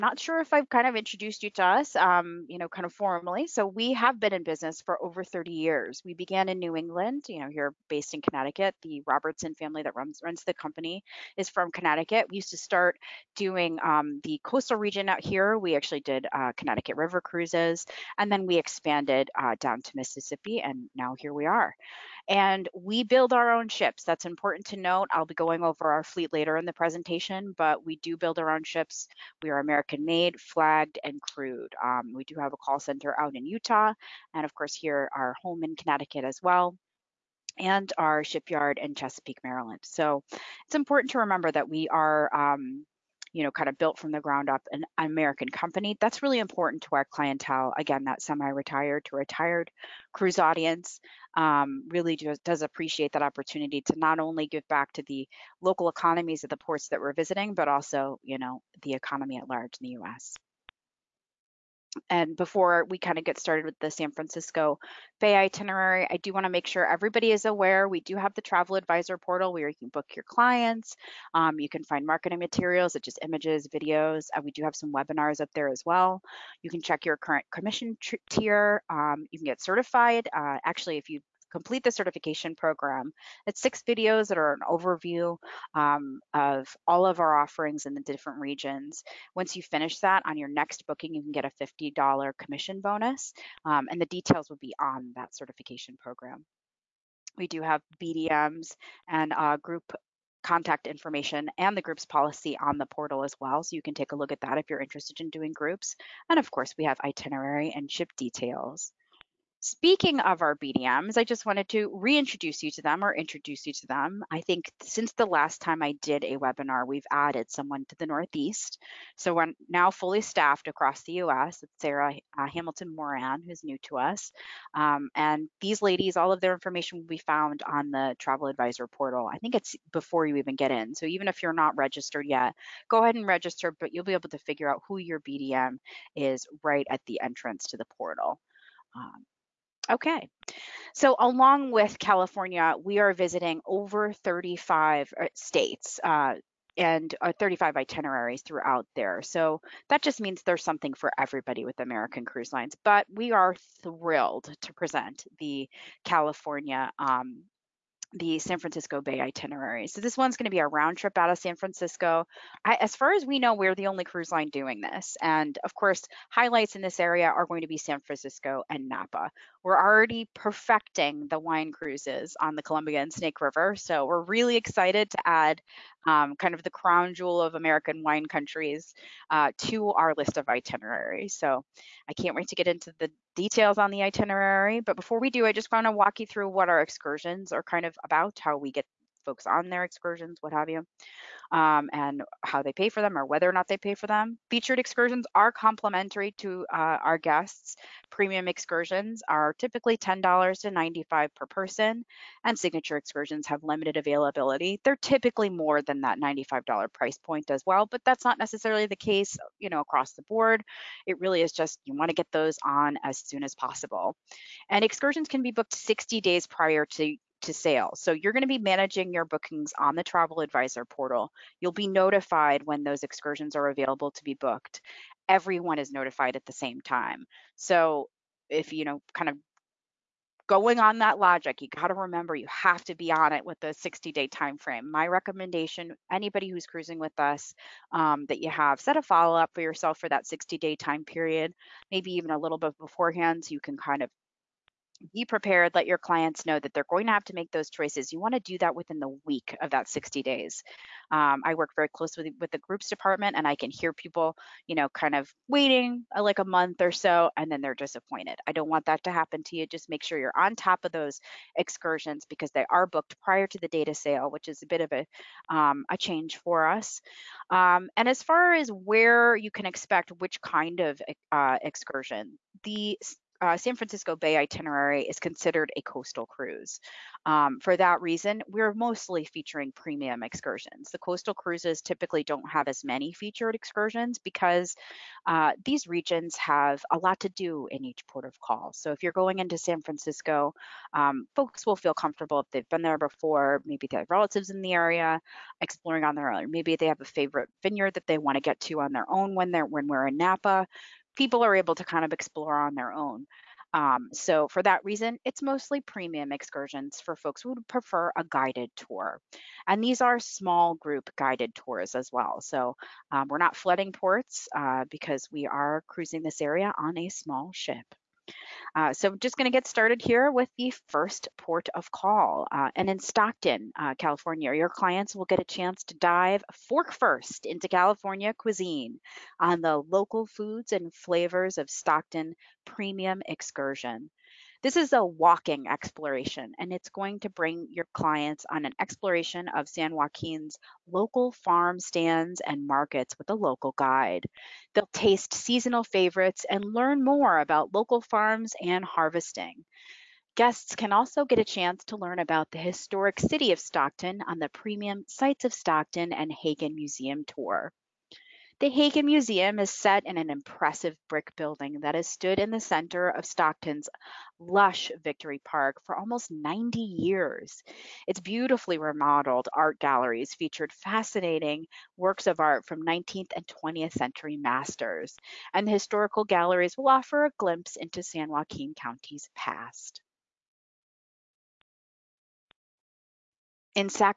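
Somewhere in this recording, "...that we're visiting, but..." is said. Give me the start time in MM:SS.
00:56.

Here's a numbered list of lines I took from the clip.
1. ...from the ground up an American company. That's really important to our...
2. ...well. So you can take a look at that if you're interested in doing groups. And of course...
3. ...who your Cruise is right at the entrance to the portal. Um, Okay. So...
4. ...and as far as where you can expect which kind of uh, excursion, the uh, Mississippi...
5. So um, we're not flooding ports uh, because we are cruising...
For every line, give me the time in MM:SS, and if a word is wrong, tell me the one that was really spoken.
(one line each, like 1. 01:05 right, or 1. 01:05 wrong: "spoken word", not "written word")
1. 00:43 right
2. 01:43 right
3. 02:14 wrong: "BDM", not "Cruise"
4. 04:27 wrong: "San", not "Mississippi"
5. 05:12 right.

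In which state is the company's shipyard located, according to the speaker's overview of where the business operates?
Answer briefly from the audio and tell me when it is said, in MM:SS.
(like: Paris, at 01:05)
Maryland, at 00:38.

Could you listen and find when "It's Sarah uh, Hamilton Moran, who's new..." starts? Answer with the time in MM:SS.
02:01.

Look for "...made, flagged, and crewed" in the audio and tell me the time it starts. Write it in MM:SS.
00:30.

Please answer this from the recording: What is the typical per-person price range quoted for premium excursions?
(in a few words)
$10 to $95.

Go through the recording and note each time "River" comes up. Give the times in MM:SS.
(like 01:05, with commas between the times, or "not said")
00:16, 02:53.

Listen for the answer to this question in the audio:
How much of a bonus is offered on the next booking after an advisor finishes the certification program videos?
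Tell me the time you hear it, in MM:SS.
01:31.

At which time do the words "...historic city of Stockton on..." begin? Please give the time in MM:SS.
05:52.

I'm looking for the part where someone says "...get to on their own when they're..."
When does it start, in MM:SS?
04:58.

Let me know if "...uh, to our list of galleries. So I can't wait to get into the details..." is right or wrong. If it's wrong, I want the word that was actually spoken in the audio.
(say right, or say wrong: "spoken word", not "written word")
wrong: "itineraries", not "galleries".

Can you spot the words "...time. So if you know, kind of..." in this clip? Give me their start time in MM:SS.
03:46.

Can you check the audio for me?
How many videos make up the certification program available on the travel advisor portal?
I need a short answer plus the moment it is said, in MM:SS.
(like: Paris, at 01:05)
6, at 01:23.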